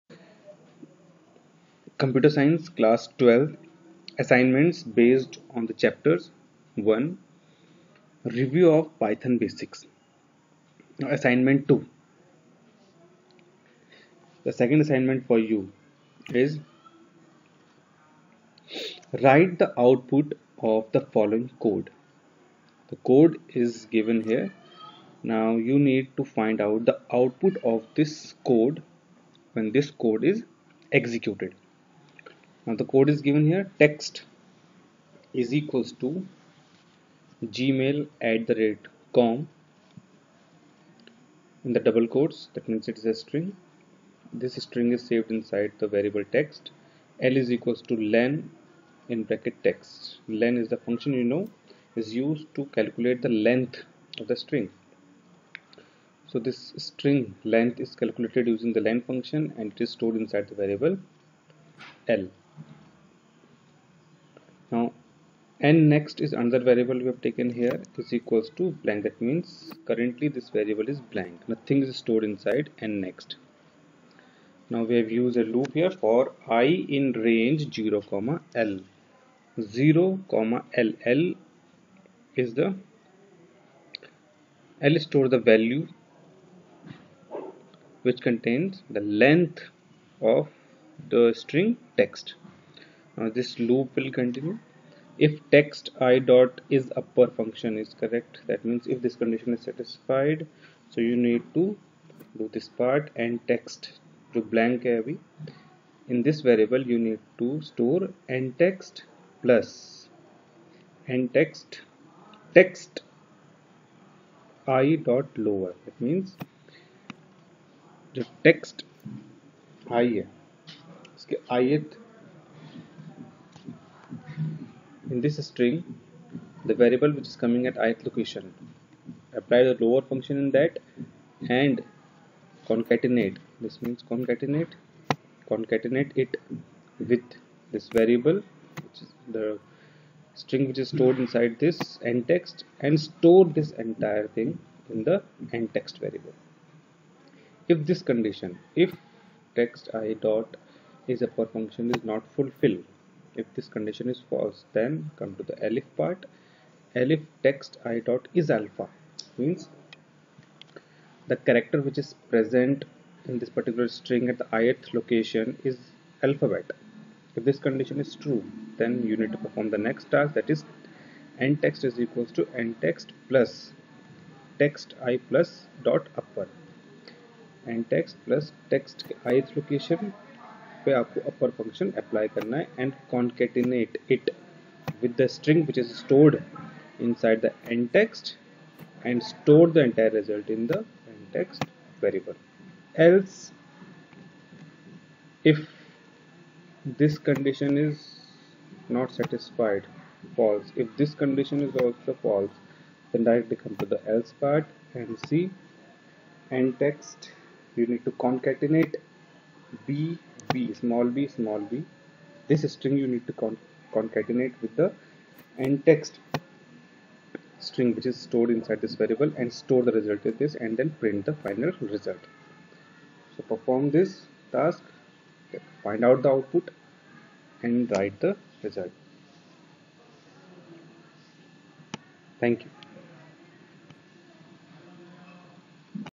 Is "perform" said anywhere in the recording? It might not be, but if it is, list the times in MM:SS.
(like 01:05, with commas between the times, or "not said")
02:49, 03:43.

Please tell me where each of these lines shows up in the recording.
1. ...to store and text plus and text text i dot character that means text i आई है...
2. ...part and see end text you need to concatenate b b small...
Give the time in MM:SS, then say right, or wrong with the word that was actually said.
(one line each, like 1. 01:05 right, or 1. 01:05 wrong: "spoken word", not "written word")
1. 01:47 wrong: "lower", not "character"
2. 03:24 right.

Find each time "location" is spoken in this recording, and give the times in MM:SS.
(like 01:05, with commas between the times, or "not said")
02:08, 02:44, 02:59.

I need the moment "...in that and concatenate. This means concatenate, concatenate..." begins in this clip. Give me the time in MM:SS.
02:10.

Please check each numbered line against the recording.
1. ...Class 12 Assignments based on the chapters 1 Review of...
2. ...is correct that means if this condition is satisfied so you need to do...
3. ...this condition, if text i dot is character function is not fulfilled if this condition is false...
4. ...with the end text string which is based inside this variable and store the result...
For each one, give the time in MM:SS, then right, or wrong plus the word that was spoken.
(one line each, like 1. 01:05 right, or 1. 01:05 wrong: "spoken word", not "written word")
1. 00:02 right
2. 01:37 right
3. 02:27 wrong: "upper", not "character"
4. 03:34 wrong: "stored", not "based".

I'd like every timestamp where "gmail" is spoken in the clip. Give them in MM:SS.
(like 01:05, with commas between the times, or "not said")
00:37.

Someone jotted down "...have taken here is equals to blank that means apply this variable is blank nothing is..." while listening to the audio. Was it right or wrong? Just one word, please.
wrong.